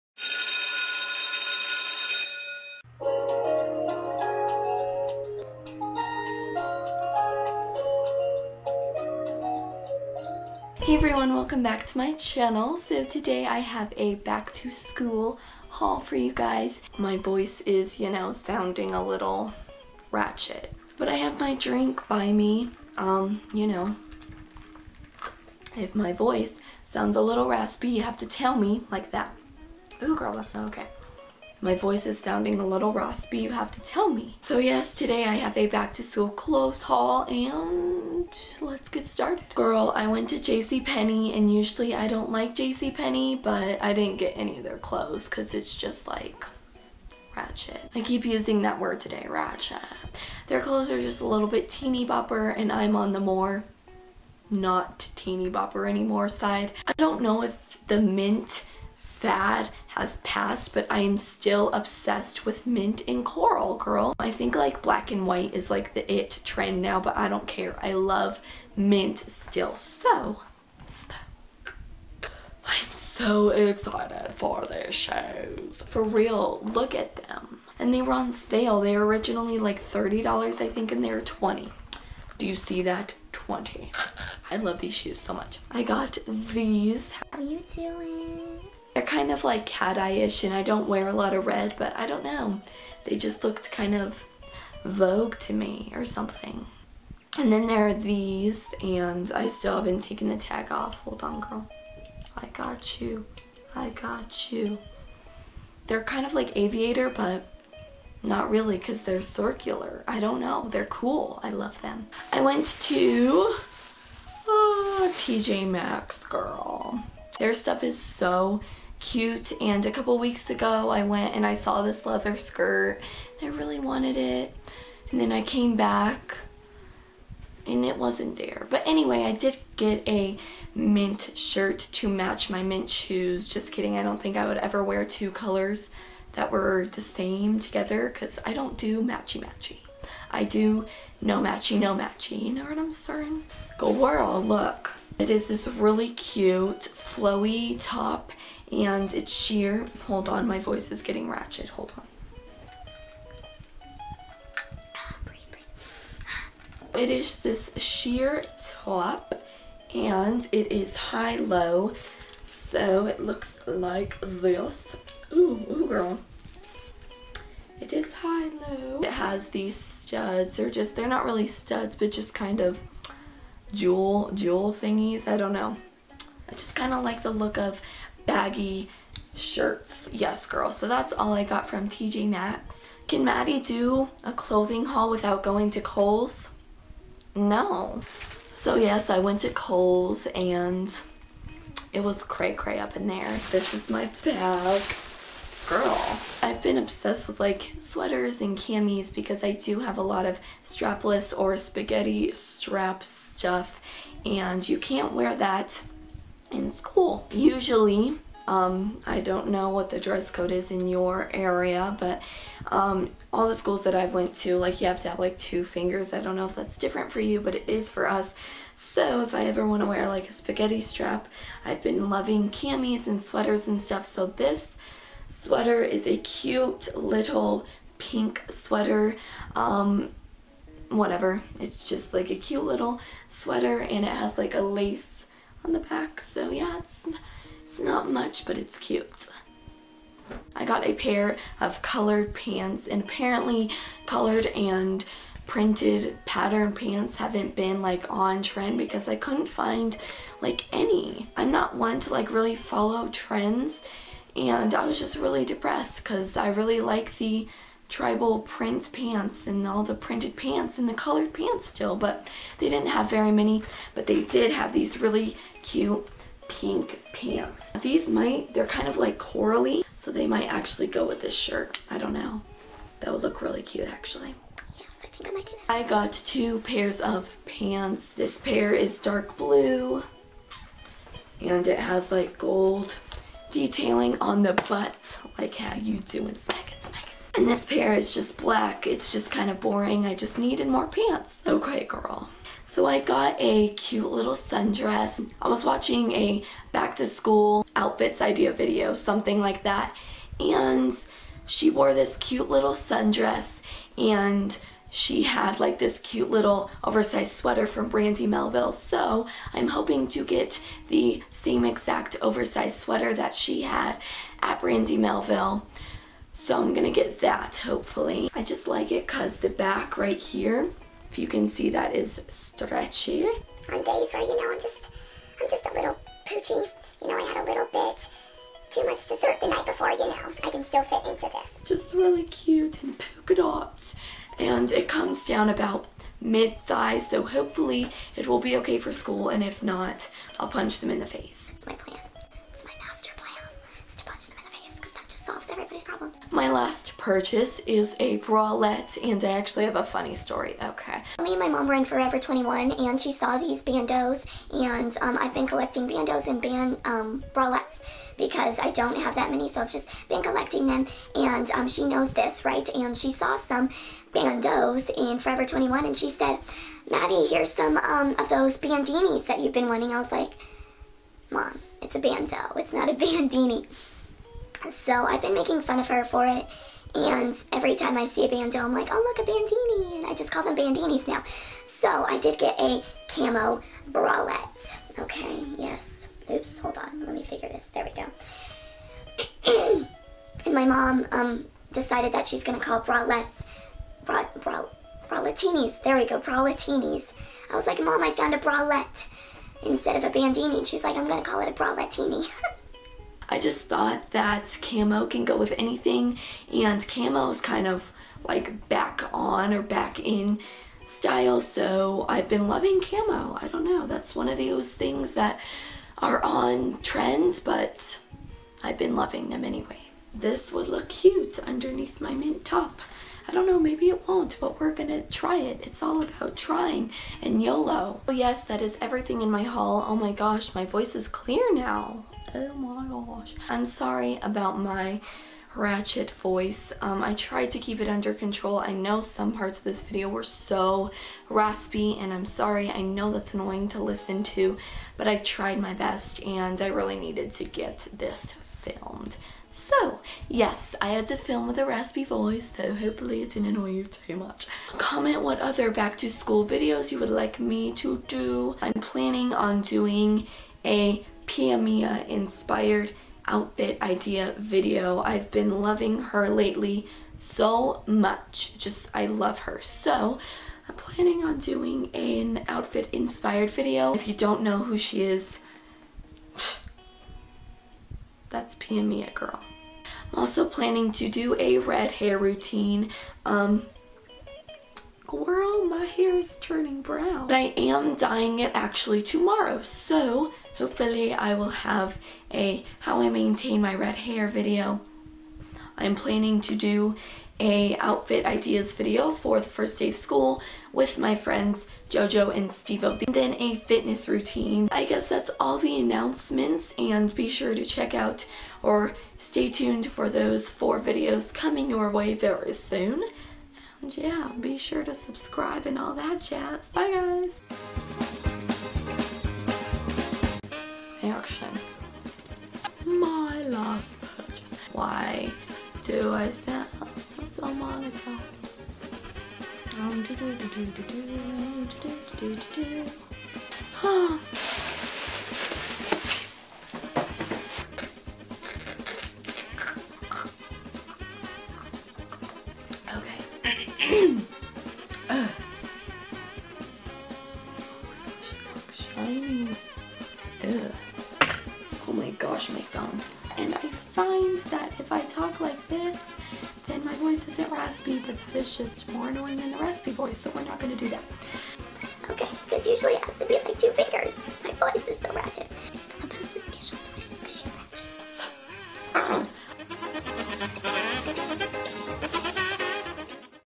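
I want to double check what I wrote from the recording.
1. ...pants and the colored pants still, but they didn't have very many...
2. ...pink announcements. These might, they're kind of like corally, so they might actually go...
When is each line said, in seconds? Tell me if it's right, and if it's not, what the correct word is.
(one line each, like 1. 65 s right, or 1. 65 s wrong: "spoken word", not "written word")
1. 260 s right
2. 266 s wrong: "pants", not "announcements".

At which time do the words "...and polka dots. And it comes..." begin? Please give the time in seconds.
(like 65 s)
332 s.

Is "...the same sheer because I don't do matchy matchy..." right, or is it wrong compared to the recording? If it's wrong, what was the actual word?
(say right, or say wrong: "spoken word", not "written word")
wrong: "together", not "sheer".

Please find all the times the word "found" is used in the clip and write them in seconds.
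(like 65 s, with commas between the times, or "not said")
398 s.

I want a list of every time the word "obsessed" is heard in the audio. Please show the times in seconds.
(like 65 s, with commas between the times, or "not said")
61 s, 196 s.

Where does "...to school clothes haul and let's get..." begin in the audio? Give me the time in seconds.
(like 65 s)
35 s.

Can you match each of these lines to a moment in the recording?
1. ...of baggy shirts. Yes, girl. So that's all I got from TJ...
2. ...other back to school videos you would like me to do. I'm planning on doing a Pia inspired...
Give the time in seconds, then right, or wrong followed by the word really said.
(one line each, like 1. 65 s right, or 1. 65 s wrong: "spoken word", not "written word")
1. 177 s right
2. 455 s right.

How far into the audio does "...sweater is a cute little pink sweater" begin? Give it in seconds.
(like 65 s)
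225 s.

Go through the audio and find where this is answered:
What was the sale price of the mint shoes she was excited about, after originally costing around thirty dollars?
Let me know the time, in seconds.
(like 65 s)
81 s.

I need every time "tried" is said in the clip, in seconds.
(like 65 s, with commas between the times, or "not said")
437 s, 445 s.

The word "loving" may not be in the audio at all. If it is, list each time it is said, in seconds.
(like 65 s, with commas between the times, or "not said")
222 s, 412 s, 418 s, 465 s.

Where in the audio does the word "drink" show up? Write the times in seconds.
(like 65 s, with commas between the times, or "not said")
21 s.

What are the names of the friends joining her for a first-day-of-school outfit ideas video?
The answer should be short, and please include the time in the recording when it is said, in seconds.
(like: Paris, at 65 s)
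Jojo and Stevo, at 501 s.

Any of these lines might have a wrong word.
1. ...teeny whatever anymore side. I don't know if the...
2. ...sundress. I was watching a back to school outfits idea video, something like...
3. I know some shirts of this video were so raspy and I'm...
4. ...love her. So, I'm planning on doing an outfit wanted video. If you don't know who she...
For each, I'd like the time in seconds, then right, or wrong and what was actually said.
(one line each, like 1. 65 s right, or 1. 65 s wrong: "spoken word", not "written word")
1. 55 s wrong: "bopper", not "whatever"
2. 294 s right
3. 438 s wrong: "parts", not "shirts"
4. 469 s wrong: "inspired", not "wanted".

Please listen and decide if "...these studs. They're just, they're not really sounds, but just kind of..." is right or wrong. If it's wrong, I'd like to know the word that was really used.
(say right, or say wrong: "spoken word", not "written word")
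wrong: "studs", not "sounds".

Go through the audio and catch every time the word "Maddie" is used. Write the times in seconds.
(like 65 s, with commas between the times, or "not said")
183 s, 366 s.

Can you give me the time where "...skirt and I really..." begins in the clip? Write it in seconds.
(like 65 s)
122 s.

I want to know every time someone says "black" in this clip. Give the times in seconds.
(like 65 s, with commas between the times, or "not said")
64 s, 288 s.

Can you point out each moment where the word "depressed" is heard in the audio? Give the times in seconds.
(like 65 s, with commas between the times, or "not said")
255 s.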